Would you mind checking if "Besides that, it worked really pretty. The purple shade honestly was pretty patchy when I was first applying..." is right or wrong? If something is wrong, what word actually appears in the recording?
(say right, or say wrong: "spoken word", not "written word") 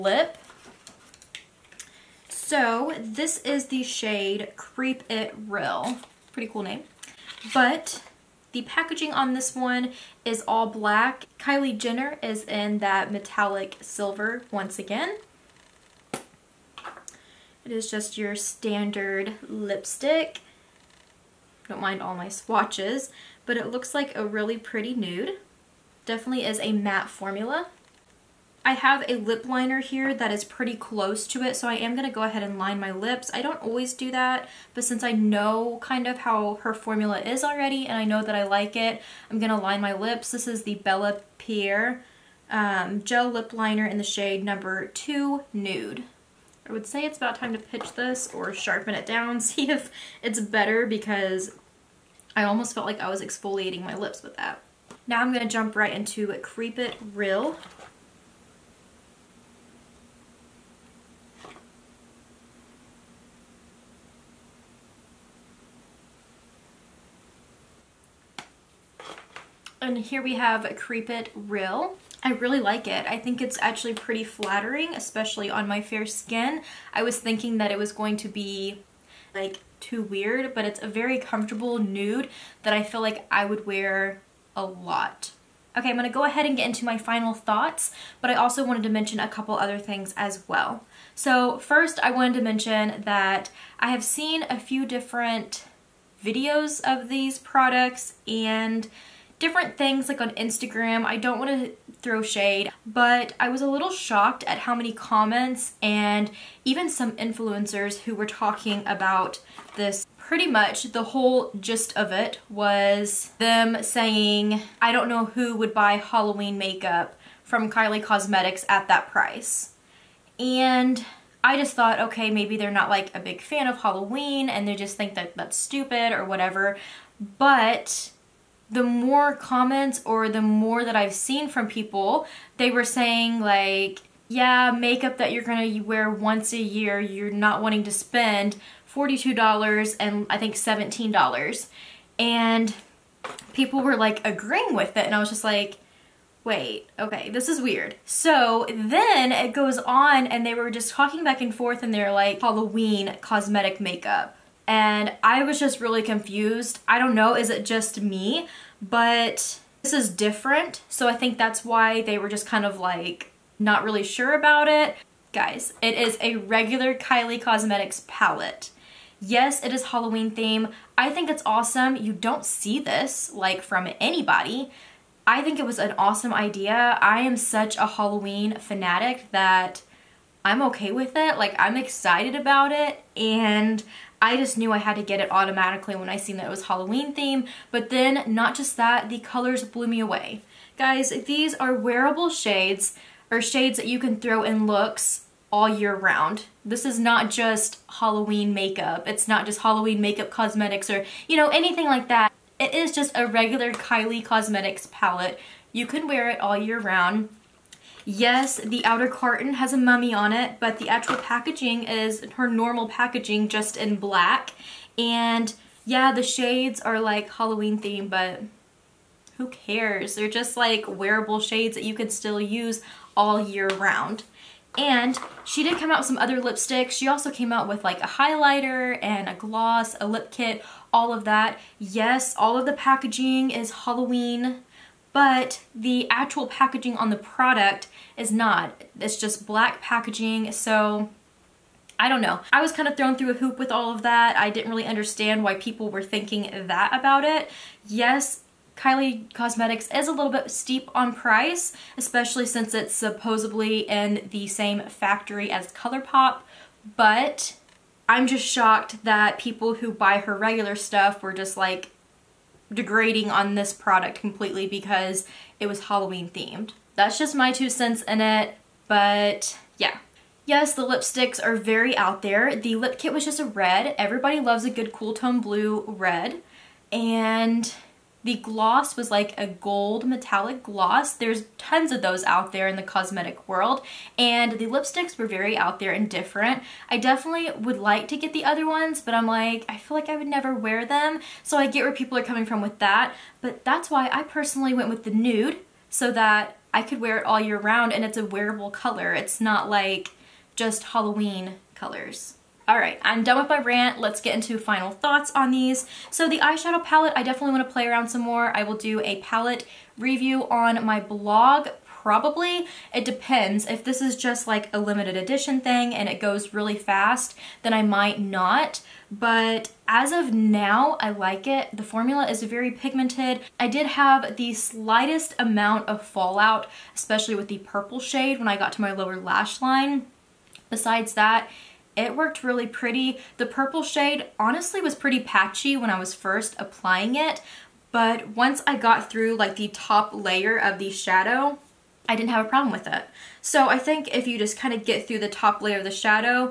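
right.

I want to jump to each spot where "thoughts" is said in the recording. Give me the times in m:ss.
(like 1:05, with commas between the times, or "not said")
1:27, 2:01, 5:04.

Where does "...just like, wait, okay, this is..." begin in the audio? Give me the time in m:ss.
2:25.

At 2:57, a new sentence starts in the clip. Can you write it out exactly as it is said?
I am such a Halloween fanatic that I'm okay with it.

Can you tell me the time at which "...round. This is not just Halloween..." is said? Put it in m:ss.
3:15.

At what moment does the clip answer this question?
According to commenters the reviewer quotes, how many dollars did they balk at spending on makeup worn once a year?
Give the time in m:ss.
2:18.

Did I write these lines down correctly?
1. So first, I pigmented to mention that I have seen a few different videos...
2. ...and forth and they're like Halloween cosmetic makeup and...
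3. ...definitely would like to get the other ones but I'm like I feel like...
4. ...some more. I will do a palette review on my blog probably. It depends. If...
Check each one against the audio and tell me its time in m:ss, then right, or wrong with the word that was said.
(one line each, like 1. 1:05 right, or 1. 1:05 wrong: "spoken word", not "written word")
1. 1:31 wrong: "wanted", not "pigmented"
2. 2:31 right
3. 4:46 right
4. 5:08 right.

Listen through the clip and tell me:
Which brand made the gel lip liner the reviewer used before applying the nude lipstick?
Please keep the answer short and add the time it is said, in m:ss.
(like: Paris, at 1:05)
Bella Pierre, at 0:40.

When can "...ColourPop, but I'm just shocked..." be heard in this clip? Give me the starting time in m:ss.
4:15.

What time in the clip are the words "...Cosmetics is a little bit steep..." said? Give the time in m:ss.
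4:09.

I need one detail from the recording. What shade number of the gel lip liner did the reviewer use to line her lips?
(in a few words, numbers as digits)
2.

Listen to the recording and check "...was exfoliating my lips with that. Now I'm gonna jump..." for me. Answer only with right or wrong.
right.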